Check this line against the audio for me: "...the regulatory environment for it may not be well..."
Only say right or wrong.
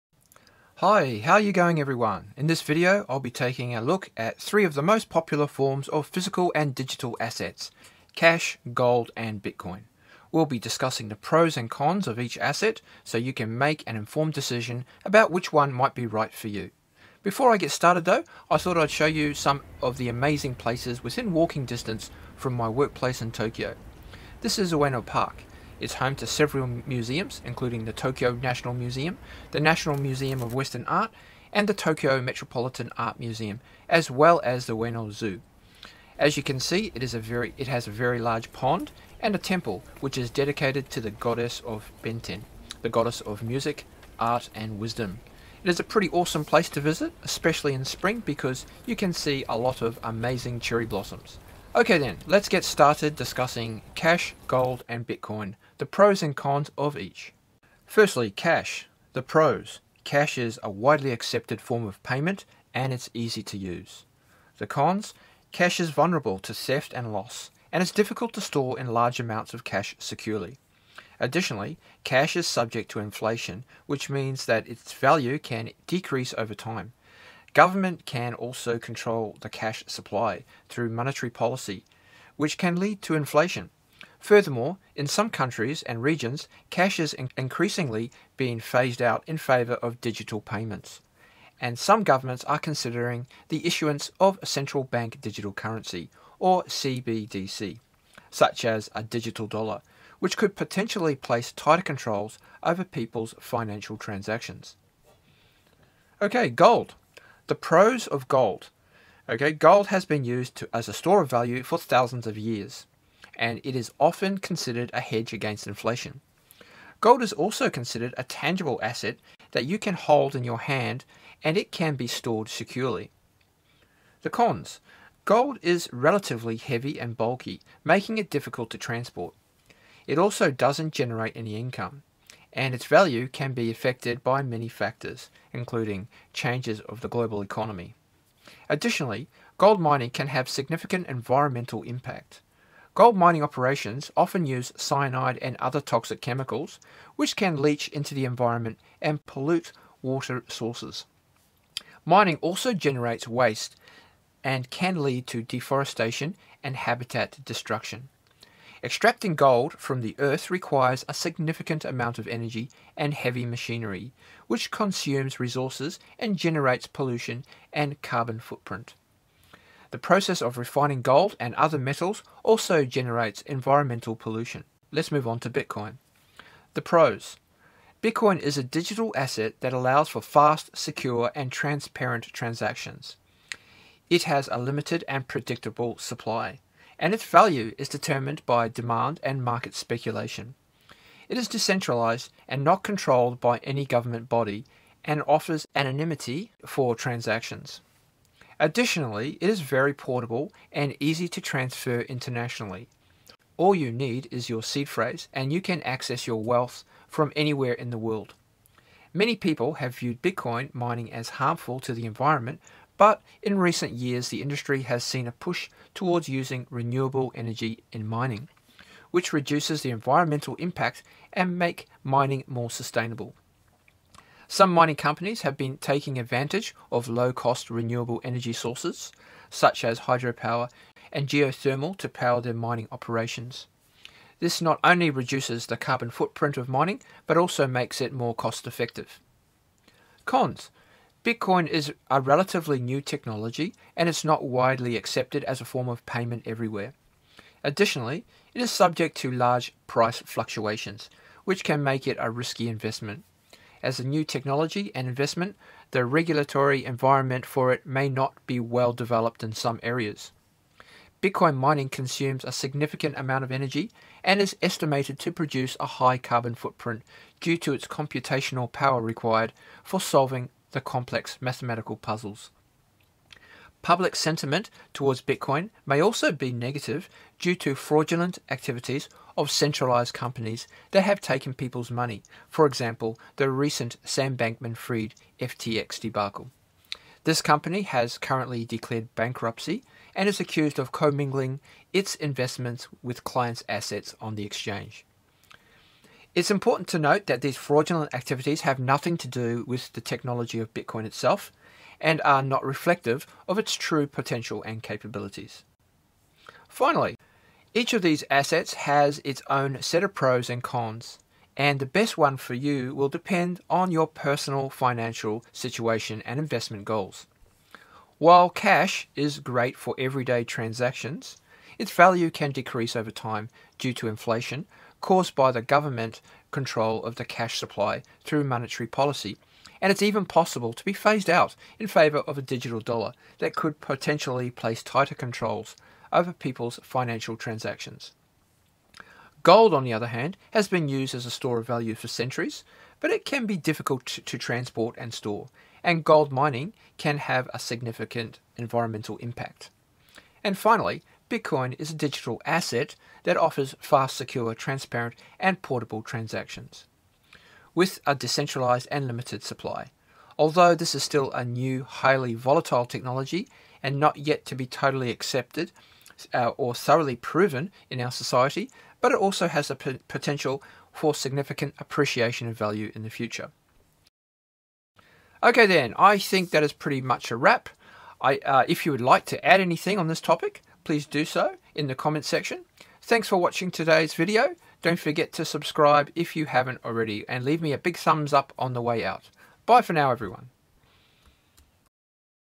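right.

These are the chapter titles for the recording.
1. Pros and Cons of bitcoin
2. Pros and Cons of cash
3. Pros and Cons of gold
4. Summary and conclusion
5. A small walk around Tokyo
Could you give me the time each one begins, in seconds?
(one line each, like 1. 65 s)
1. 174 s
2. 55 s
3. 106 s
4. 305 s
5. 18 s.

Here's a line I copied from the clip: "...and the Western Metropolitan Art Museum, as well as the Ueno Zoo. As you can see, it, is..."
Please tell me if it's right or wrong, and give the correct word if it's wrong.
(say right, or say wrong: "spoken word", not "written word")
wrong: "Tokyo", not "Western".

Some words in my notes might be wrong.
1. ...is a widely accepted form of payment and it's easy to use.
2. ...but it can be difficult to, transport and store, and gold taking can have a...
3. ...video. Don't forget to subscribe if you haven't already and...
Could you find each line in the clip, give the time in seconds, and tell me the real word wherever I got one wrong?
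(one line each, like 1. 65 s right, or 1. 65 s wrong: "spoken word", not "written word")
1. 60 s right
2. 342 s wrong: "mining", not "taking"
3. 384 s right.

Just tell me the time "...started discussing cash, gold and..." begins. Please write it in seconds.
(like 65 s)
52 s.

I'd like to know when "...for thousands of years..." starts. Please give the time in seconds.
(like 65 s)
111 s.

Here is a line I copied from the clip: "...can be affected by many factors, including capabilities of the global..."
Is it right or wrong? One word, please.
wrong.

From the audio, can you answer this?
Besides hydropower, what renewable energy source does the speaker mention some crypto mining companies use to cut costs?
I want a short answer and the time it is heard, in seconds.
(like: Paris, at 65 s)
geothermal, at 231 s.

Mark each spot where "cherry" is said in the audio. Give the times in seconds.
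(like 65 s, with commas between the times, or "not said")
50 s.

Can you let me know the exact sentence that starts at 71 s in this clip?
Additionally, cash is subject to inflation, which means that its value can decrease over time.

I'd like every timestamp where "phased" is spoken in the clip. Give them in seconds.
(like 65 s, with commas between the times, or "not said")
88 s, 330 s.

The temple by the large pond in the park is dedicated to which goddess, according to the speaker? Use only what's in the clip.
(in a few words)
Benten.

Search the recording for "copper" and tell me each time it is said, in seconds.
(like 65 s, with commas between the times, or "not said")
not said.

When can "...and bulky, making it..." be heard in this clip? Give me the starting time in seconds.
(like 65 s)
127 s.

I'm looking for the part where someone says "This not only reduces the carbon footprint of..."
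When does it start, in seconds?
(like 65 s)
234 s.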